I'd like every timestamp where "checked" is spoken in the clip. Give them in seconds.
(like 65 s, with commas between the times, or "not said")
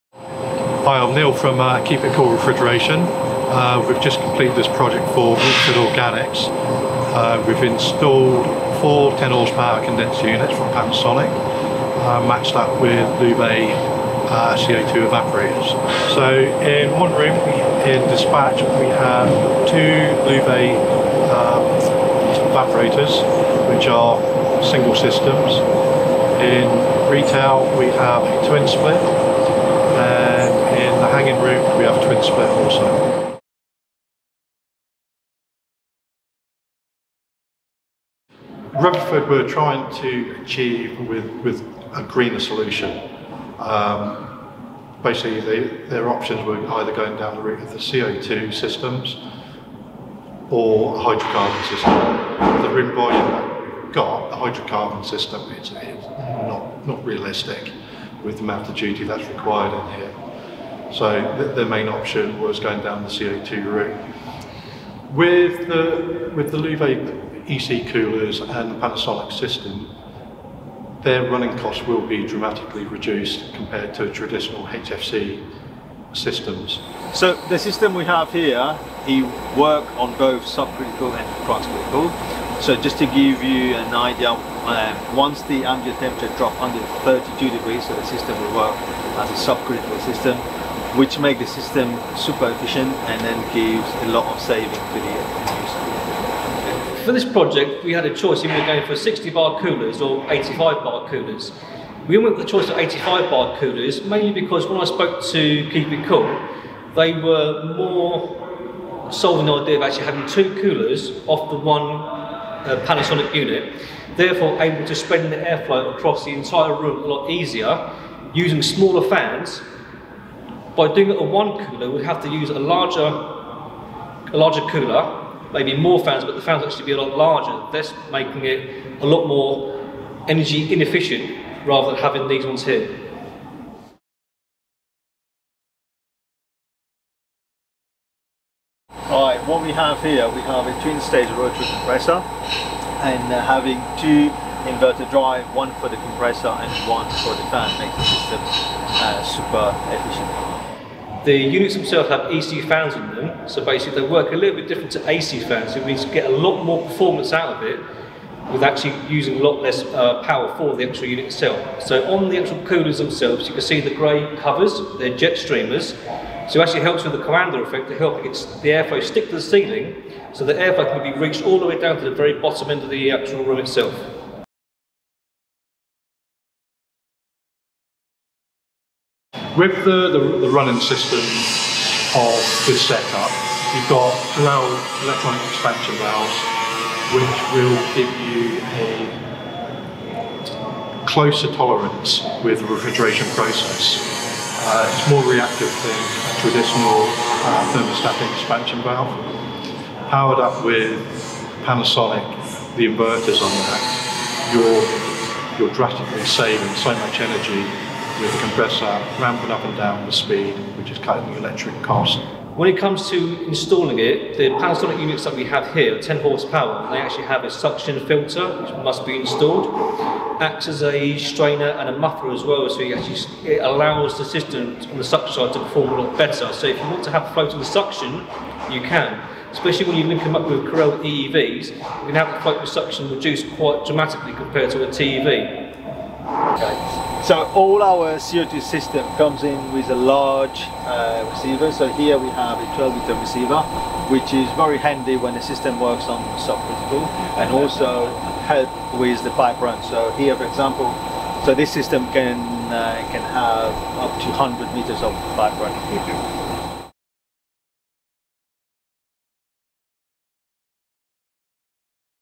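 not said.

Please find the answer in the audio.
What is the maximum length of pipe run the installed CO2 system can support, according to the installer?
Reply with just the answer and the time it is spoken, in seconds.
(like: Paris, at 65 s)
100 meters, at 254 s.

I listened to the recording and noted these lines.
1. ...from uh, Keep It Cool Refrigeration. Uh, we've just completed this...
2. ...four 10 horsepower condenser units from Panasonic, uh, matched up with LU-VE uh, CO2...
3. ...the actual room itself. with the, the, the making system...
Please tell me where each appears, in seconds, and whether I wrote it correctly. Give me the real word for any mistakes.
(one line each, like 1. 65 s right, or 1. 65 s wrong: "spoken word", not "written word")
1. 1 s right
2. 8 s right
3. 172 s wrong: "running", not "making".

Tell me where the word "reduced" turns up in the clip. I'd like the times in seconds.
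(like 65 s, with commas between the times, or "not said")
72 s, 233 s.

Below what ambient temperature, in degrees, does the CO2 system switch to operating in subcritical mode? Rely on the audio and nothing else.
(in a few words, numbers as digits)
32 degrees.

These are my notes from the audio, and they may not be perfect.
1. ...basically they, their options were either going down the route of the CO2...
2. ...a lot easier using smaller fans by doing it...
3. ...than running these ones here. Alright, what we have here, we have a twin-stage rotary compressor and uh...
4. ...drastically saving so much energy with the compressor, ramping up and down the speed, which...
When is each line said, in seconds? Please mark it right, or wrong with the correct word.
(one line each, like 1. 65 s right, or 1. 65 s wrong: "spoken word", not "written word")
1. 45 s right
2. 117 s right
3. 131 s wrong: "having", not "running"
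4. 205 s right.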